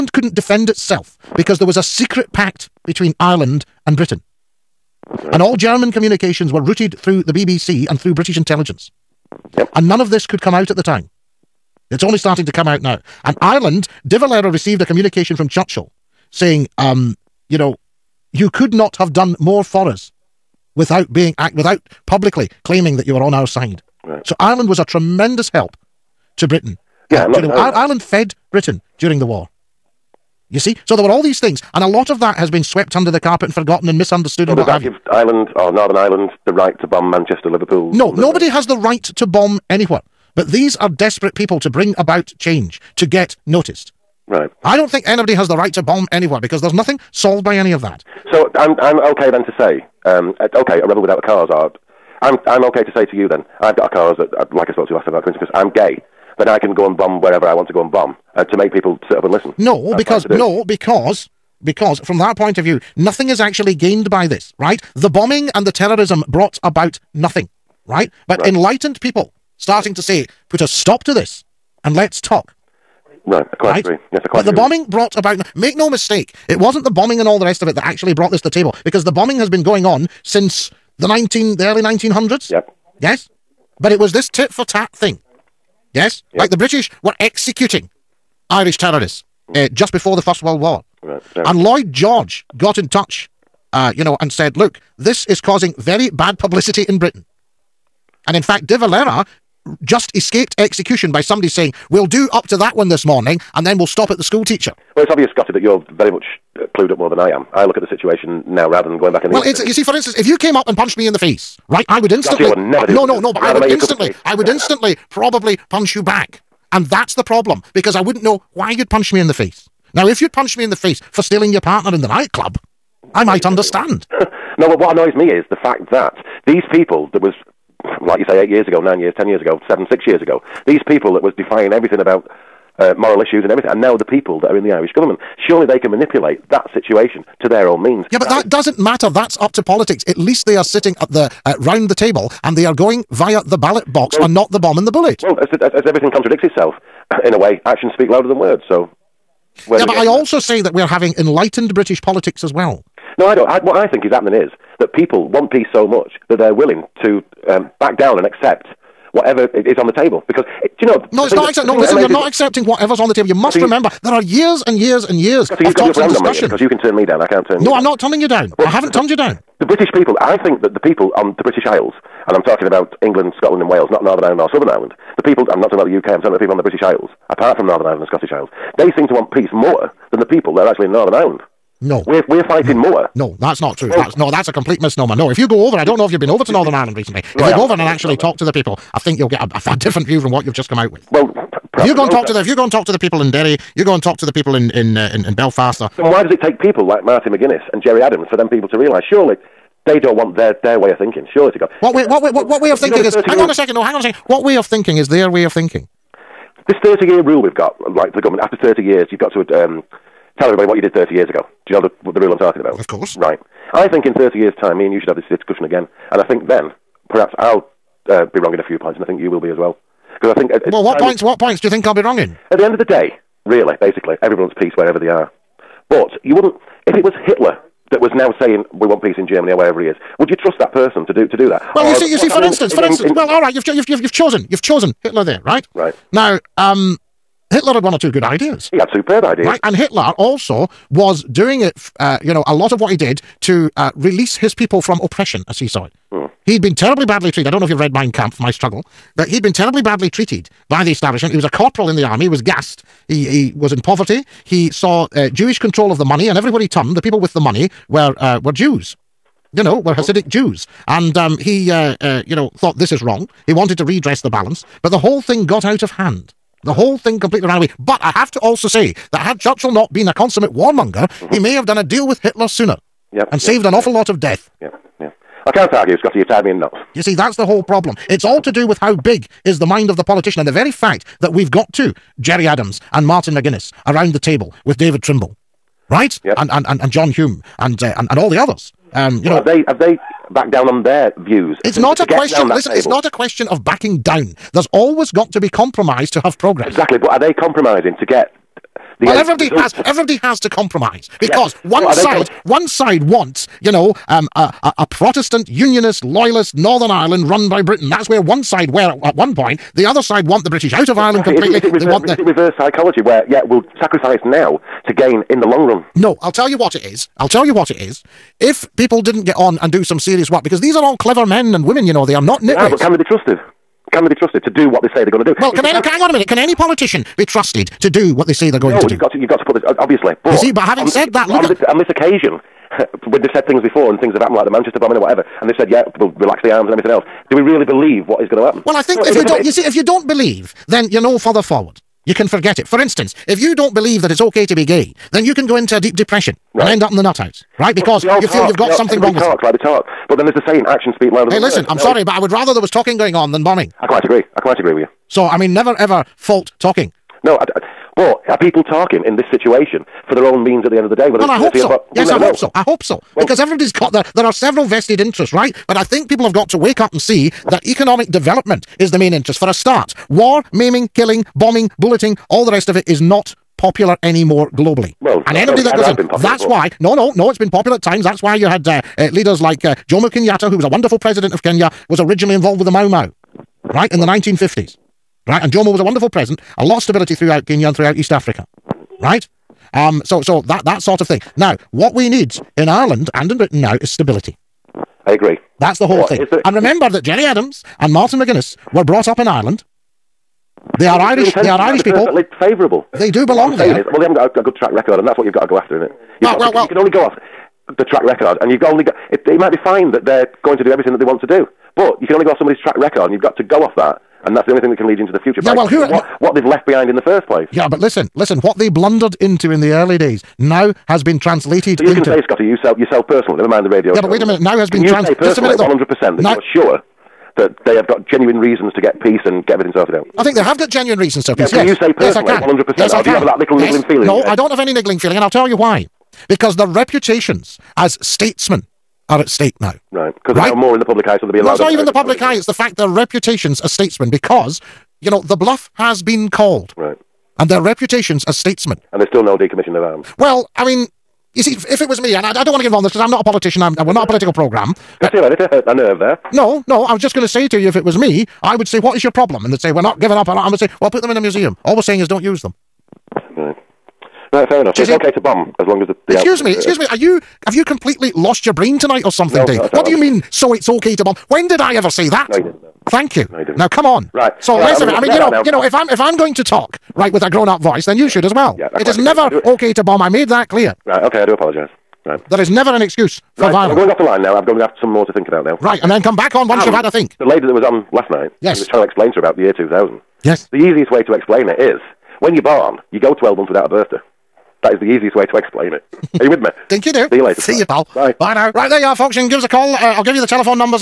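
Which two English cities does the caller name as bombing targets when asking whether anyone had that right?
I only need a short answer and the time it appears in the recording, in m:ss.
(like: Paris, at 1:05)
Manchester, Liverpool, at 0:37.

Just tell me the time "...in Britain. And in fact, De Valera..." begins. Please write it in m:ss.
1:36.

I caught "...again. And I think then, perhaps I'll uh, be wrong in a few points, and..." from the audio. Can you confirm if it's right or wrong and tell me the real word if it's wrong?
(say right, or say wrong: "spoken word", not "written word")
right.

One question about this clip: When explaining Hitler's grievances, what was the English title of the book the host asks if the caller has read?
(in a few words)
My Struggle.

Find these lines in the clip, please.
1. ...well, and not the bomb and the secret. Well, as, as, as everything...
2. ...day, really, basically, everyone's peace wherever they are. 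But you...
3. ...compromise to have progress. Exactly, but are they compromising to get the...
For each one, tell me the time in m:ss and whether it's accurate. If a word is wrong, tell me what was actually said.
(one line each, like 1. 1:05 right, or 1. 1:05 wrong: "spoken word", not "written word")
1. 2:24 wrong: "bullet", not "secret"
2. 3:42 right
3. 4:55 right.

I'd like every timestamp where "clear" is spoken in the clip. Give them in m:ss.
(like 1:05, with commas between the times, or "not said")
8:00.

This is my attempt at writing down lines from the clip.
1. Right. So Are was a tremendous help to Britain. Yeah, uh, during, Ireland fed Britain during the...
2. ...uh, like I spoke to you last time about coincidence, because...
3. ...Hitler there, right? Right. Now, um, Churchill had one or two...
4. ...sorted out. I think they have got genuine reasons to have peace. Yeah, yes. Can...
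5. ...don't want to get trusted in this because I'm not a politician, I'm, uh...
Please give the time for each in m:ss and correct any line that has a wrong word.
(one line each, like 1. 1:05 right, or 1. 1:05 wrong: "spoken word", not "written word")
1. 0:24 wrong: "Ireland", not "Are"
2. 0:54 right
3. 3:55 wrong: "Hitler", not "Churchill"
4. 7:09 right
5. 7:32 wrong: "involved", not "trusted".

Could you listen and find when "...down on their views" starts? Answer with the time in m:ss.
4:50.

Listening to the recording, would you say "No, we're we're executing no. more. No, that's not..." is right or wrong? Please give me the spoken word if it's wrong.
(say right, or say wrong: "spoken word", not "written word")
wrong: "fighting", not "executing".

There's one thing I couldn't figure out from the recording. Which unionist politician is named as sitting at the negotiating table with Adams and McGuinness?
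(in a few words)
David Trimble.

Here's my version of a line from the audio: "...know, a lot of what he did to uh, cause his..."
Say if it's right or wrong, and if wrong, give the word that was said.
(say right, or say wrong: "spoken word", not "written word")
wrong: "release", not "cause".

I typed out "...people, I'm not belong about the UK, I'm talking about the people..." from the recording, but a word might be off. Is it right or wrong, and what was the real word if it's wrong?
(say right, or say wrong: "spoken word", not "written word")
wrong: "talking", not "belong".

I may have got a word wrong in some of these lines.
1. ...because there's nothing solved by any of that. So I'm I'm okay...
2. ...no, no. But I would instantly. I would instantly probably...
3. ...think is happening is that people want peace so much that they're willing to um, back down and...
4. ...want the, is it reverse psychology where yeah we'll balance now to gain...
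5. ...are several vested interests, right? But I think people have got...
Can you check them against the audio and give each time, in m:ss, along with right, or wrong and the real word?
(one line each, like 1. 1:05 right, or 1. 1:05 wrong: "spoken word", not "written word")
1. 0:46 right
2. 1:53 right
3. 2:33 right
4. 5:11 wrong: "sacrifice", not "balance"
5. 6:04 right.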